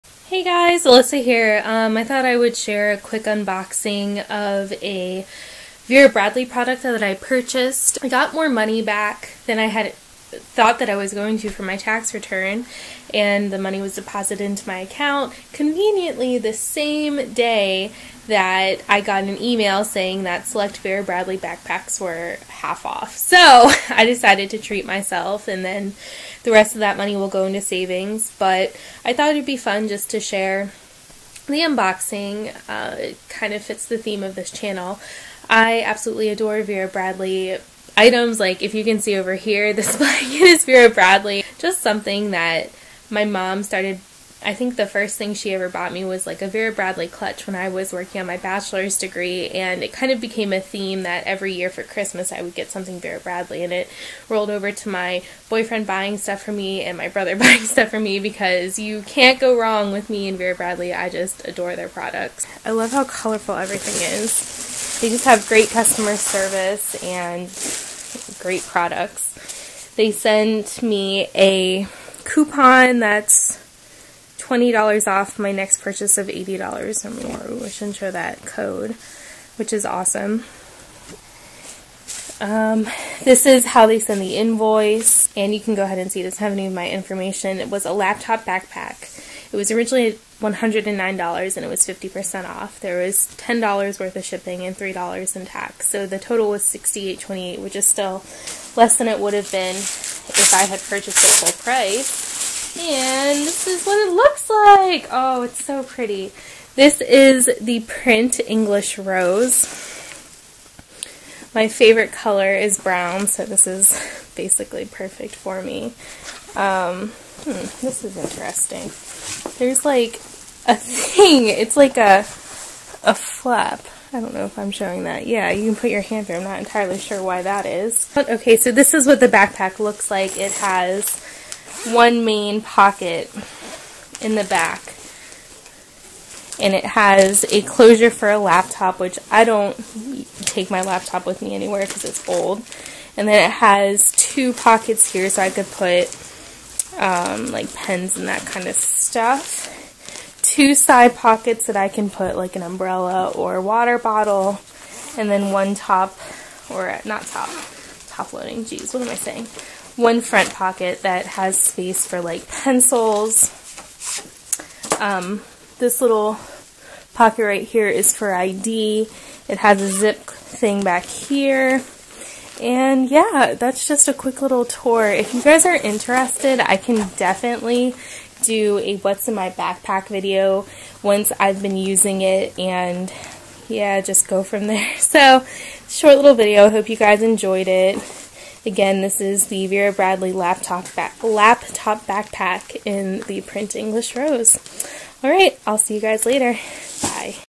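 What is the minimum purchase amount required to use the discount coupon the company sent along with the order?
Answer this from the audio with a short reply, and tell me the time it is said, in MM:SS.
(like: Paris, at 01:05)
$80, at 01:16.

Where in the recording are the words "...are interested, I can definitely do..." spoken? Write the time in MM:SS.
02:55.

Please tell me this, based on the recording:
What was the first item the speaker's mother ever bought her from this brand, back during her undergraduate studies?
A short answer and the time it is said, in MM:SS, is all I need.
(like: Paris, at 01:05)
clutch, at 00:47.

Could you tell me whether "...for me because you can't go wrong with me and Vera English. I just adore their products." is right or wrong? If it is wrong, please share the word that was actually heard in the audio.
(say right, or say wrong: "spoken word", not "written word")
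wrong: "Bradley", not "English".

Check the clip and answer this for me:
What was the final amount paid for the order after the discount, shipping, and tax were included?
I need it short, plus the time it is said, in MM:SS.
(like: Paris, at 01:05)
$68.28, at 01:36.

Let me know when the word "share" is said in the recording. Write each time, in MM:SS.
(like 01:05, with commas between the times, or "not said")
00:02, 00:30.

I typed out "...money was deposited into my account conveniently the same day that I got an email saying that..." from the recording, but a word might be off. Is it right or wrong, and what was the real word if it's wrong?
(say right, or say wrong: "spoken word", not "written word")
right.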